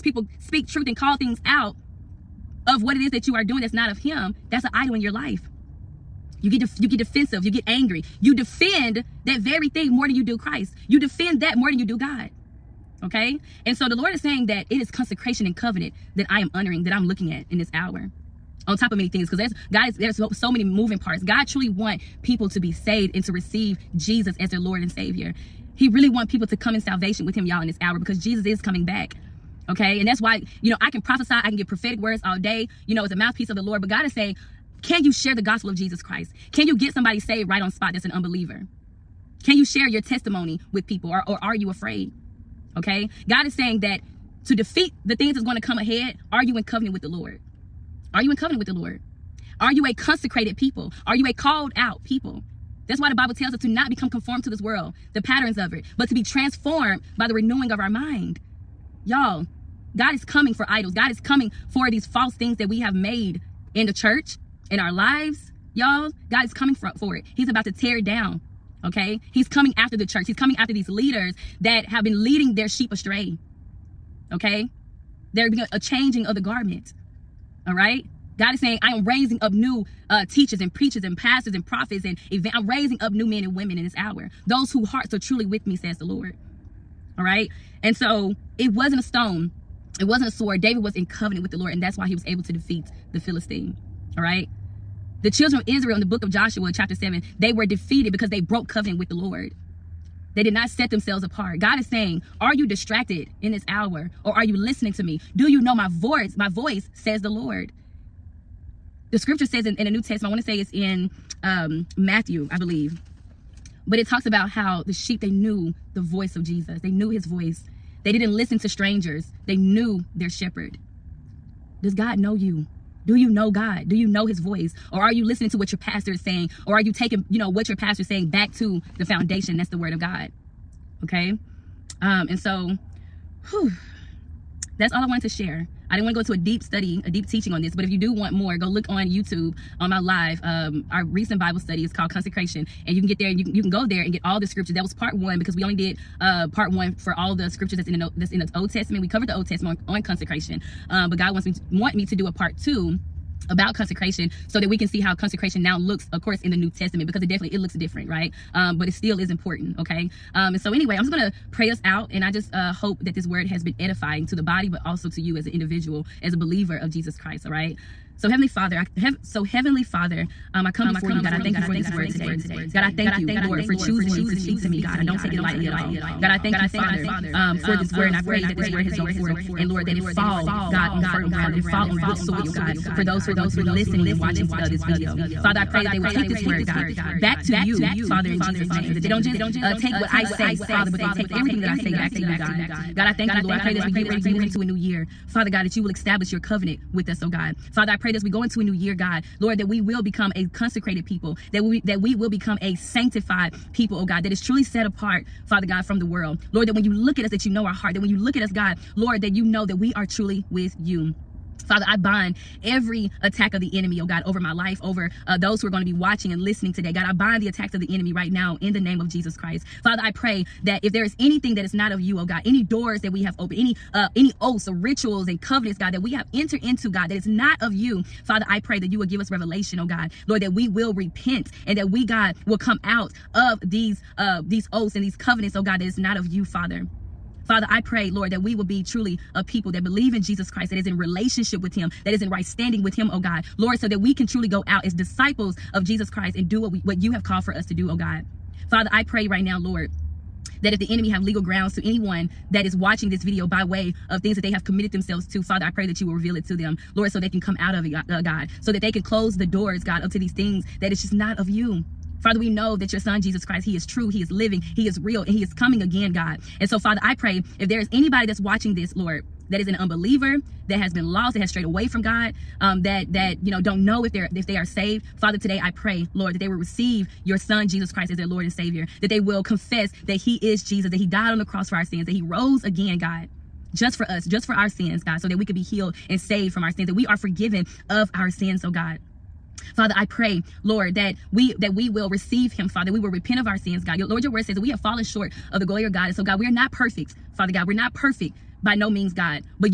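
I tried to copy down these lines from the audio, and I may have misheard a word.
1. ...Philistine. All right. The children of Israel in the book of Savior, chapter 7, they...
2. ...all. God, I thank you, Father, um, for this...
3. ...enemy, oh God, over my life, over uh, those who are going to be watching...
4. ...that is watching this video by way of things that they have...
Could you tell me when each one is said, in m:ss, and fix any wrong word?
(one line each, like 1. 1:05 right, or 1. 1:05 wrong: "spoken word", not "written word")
1. 1:33 wrong: "Joshua", not "Savior"
2. 2:55 right
3. 3:33 right
4. 4:12 right.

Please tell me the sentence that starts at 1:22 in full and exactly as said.
I'm raising up new men and women in this hour.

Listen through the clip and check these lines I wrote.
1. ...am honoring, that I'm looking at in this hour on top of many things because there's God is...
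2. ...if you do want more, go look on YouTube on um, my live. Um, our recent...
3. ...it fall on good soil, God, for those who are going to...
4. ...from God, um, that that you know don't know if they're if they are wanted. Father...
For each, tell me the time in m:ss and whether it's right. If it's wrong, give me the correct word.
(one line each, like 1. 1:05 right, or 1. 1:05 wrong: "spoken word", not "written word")
1. 0:16 right
2. 2:17 right
3. 3:01 right
4. 4:31 wrong: "saved", not "wanted".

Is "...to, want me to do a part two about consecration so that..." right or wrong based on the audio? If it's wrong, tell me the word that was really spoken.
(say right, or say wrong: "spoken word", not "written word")
right.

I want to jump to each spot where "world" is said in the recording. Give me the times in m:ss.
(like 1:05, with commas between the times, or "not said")
0:54, 3:26.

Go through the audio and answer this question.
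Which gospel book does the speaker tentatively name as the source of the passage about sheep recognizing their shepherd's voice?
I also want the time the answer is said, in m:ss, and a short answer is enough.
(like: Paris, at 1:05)
Matthew, at 1:51.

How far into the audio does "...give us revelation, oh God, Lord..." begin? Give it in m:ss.
3:49.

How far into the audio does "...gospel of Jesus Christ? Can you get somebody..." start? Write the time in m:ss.
0:35.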